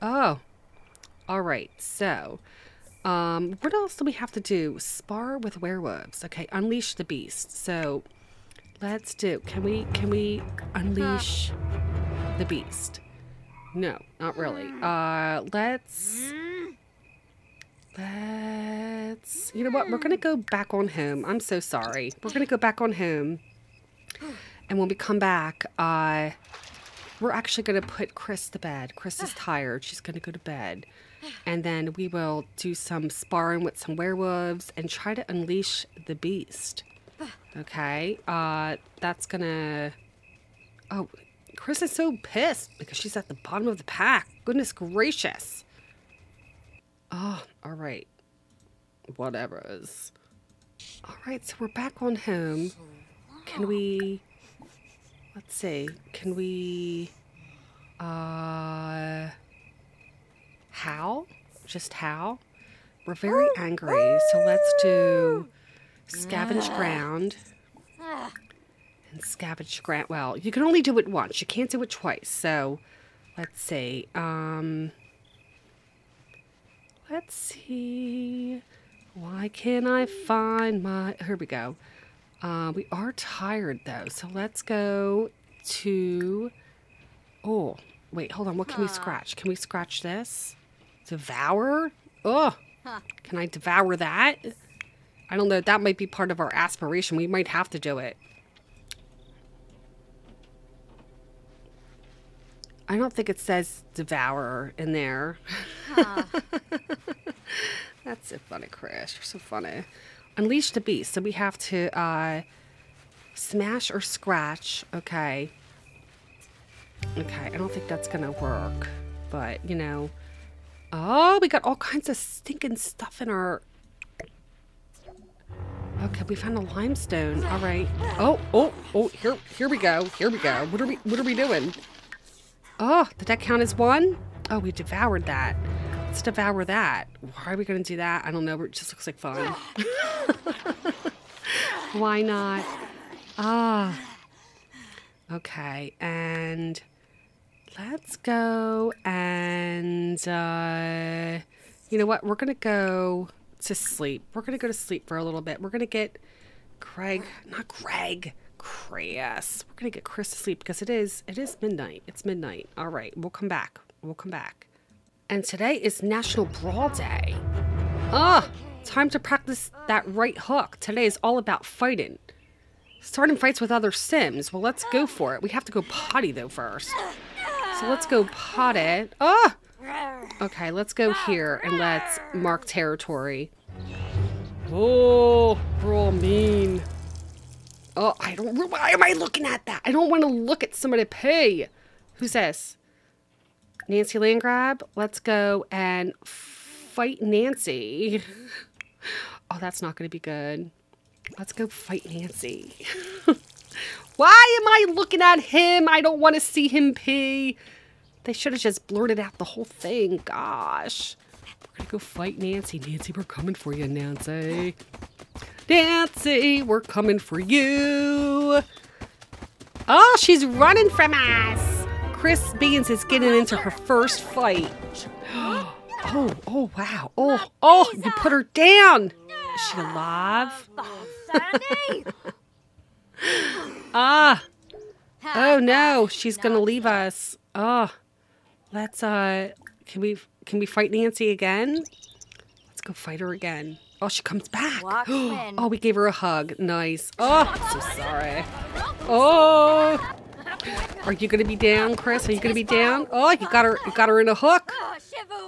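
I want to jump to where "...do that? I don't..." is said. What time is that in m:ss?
2:17.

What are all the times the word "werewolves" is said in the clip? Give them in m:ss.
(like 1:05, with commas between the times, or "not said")
0:05, 0:33.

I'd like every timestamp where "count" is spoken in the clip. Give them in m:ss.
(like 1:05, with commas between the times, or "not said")
2:13.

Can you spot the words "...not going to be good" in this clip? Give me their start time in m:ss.
3:19.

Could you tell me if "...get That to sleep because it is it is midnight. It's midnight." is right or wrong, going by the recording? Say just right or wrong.
wrong.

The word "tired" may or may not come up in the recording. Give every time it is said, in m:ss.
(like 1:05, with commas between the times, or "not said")
0:29, 1:23.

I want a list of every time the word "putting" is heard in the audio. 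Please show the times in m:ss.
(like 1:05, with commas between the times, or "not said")
not said.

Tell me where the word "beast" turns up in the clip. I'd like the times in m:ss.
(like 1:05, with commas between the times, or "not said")
0:07, 0:12, 0:36, 1:50.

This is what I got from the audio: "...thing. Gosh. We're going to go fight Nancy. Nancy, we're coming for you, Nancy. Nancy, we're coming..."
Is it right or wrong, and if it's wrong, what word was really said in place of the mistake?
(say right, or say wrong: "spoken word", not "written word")
right.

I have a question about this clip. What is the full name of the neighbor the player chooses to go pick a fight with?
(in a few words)
Nancy Landgrab.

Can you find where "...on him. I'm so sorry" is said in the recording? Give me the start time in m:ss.
0:20.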